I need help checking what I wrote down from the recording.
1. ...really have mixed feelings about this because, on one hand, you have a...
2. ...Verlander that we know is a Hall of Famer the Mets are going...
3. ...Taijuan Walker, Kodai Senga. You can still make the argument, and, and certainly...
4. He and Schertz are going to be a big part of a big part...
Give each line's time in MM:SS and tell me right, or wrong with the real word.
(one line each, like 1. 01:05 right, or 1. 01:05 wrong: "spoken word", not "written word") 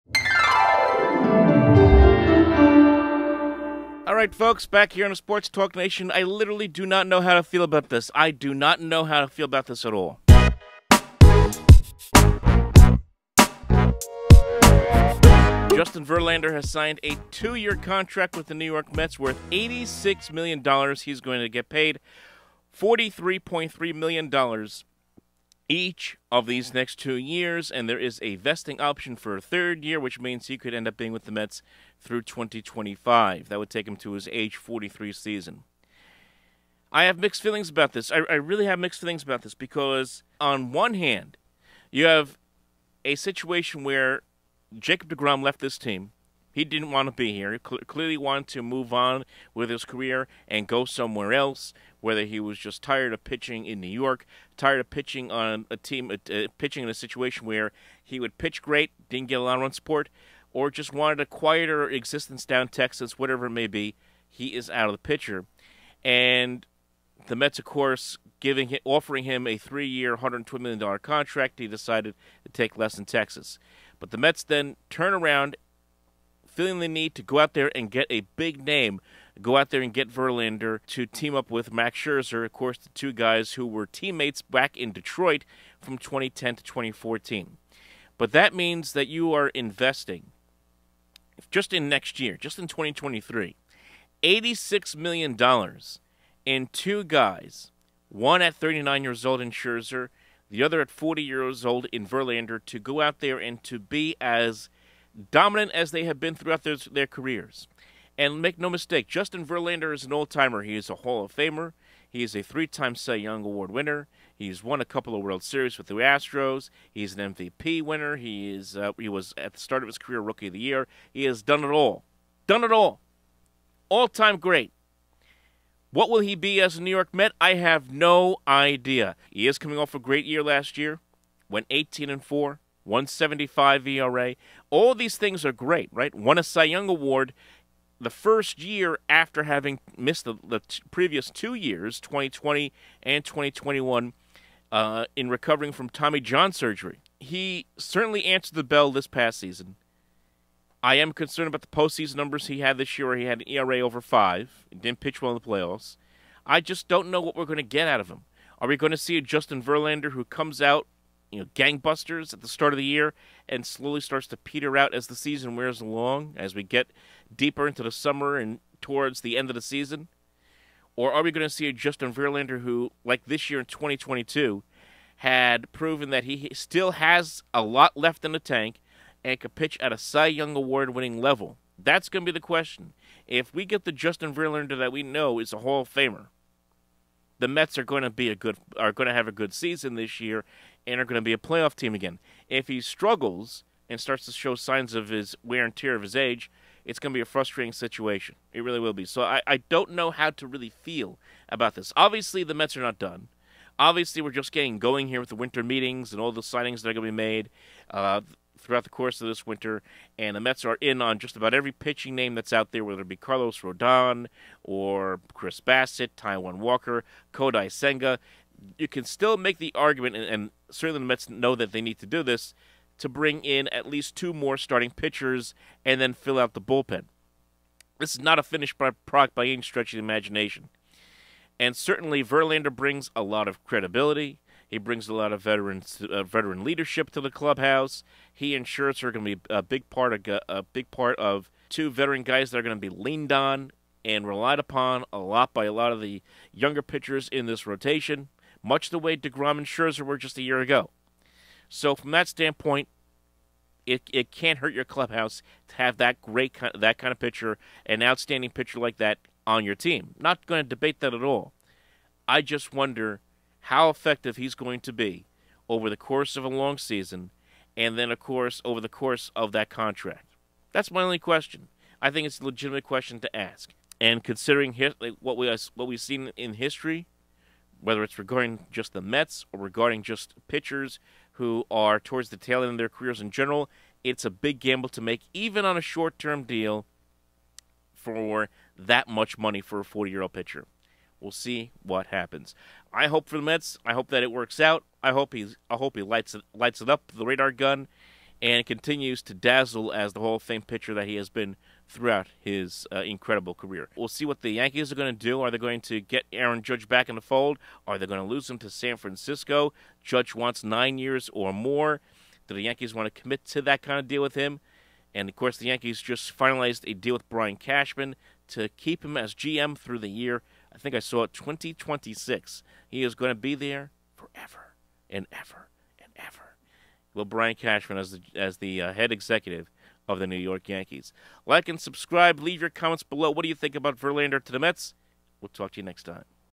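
1. 00:38 right
2. 03:04 right
3. 03:36 right
4. 03:58 right.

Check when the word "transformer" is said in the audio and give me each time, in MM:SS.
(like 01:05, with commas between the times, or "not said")
not said.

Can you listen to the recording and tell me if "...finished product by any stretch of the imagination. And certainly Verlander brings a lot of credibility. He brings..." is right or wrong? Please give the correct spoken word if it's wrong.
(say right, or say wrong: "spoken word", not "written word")
right.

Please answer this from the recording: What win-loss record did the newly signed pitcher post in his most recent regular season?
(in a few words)
18 and 4.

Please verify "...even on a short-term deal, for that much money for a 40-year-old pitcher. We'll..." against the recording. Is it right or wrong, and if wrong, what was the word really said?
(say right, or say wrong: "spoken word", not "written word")
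right.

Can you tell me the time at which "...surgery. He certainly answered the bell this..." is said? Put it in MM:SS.
02:26.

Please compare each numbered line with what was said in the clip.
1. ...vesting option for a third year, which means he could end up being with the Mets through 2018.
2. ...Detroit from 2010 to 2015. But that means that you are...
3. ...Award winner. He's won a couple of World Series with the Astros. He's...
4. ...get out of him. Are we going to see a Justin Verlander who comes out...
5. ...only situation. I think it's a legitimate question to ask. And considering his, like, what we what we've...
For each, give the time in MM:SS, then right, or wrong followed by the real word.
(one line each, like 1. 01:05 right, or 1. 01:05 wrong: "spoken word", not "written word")
1. 00:28 wrong: "2025", not "2018"
2. 01:24 wrong: "2014", not "2015"
3. 01:53 right
4. 02:37 right
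5. 04:31 wrong: "question", not "situation".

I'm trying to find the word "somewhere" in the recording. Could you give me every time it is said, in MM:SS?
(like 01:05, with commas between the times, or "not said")
00:50.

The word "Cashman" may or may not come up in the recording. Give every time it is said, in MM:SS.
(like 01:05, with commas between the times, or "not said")
05:17, 05:27.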